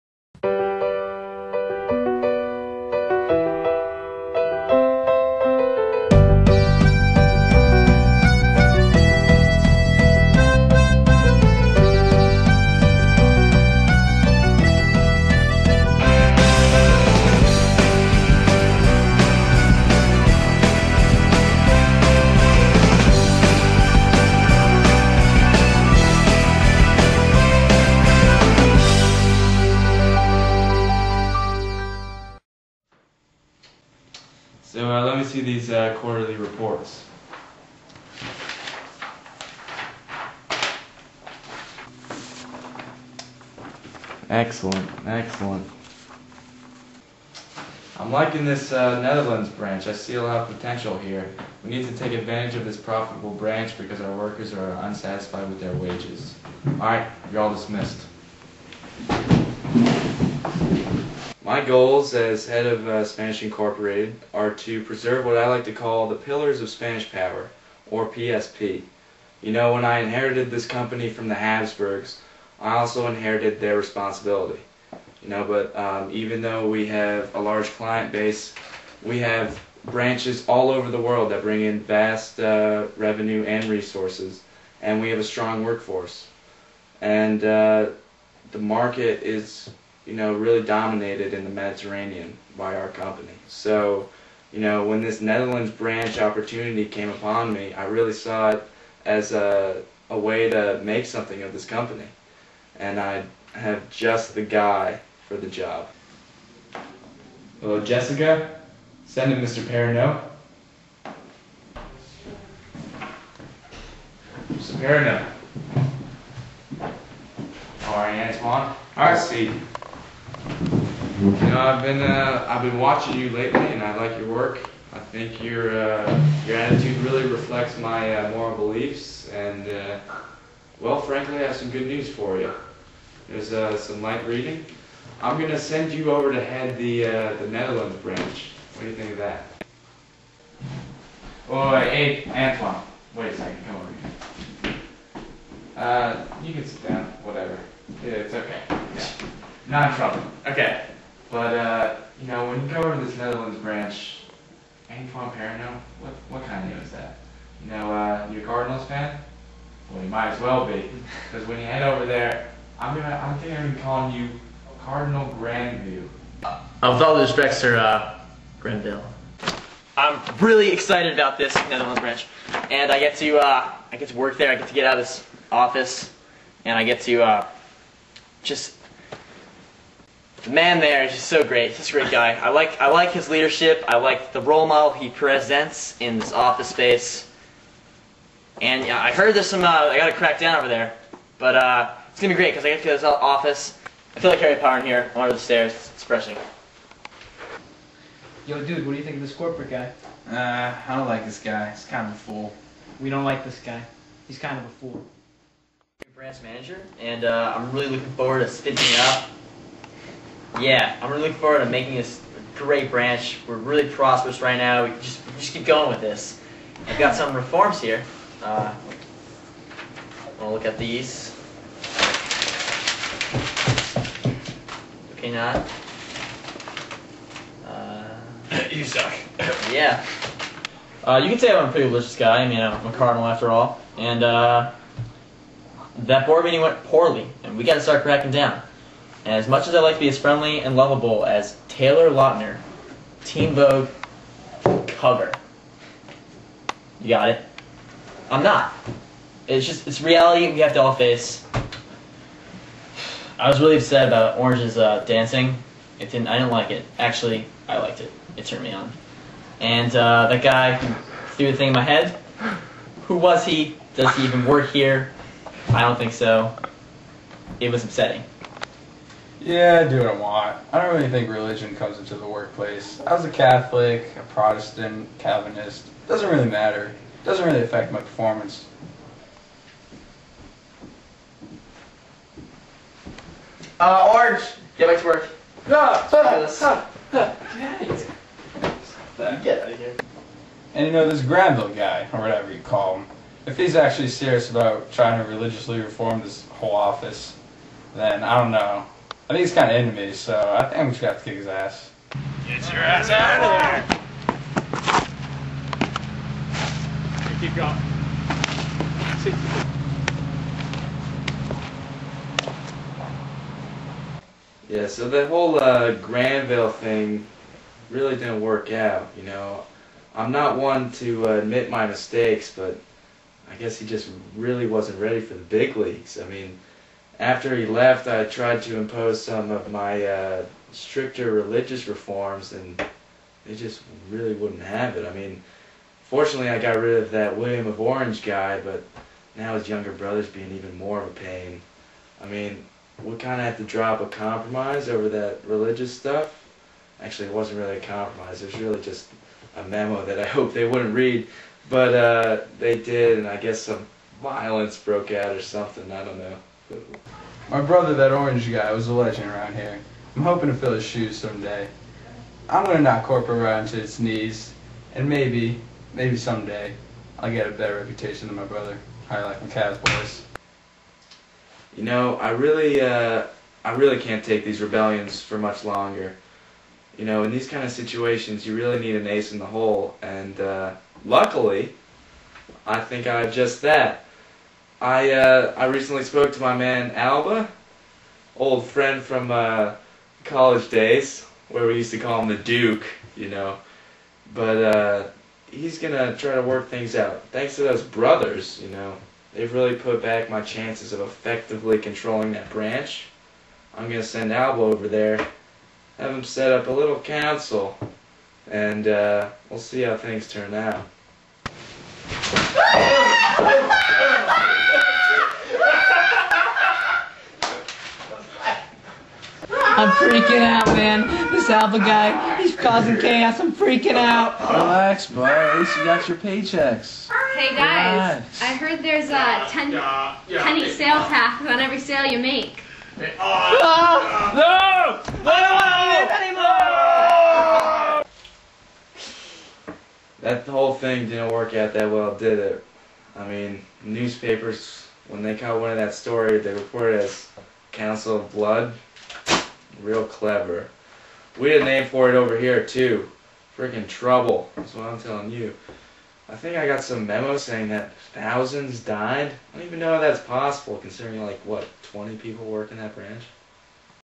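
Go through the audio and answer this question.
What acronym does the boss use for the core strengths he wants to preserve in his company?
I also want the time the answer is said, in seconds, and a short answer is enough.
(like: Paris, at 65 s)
PSP, at 68 s.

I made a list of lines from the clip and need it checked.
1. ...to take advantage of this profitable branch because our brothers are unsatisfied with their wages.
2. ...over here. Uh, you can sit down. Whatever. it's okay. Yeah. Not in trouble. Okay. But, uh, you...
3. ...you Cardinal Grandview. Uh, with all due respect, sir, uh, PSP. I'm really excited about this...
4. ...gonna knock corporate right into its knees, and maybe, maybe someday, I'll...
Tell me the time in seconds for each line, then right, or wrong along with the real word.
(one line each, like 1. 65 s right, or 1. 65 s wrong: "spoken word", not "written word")
1. 51 s wrong: "workers", not "brothers"
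2. 143 s right
3. 164 s wrong: "Grenville", not "PSP"
4. 362 s right.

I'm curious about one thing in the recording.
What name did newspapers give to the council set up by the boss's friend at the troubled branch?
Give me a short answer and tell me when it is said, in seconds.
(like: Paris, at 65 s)
Council of Blood, at 447 s.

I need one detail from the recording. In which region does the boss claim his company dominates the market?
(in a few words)
Mediterranean.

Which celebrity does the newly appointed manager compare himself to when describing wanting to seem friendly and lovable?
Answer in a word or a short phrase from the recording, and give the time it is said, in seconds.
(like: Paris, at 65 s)
Taylor Lautner, at 241 s.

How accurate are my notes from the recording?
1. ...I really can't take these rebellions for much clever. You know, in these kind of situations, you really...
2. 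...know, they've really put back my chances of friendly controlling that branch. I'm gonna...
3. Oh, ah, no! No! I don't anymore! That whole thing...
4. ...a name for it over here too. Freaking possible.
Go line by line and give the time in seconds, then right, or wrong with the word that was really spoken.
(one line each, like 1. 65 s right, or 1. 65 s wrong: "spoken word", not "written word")
1. 373 s wrong: "longer", not "clever"
2. 398 s wrong: "effectively", not "friendly"
3. 432 s right
4. 451 s wrong: "trouble", not "possible".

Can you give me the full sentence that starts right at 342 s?
I mean, we kind of had to drop a compromise over that religious stuff.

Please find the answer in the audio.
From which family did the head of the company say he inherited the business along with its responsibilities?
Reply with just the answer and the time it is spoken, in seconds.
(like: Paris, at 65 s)
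Habsburgs, at 71 s.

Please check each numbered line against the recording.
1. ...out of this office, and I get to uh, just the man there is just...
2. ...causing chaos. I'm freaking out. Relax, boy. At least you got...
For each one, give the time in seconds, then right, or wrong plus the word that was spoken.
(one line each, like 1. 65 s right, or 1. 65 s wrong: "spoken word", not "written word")
1. 174 s right
2. 422 s right.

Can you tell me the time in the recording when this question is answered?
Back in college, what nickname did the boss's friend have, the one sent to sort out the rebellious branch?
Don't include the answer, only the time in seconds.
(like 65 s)
392 s.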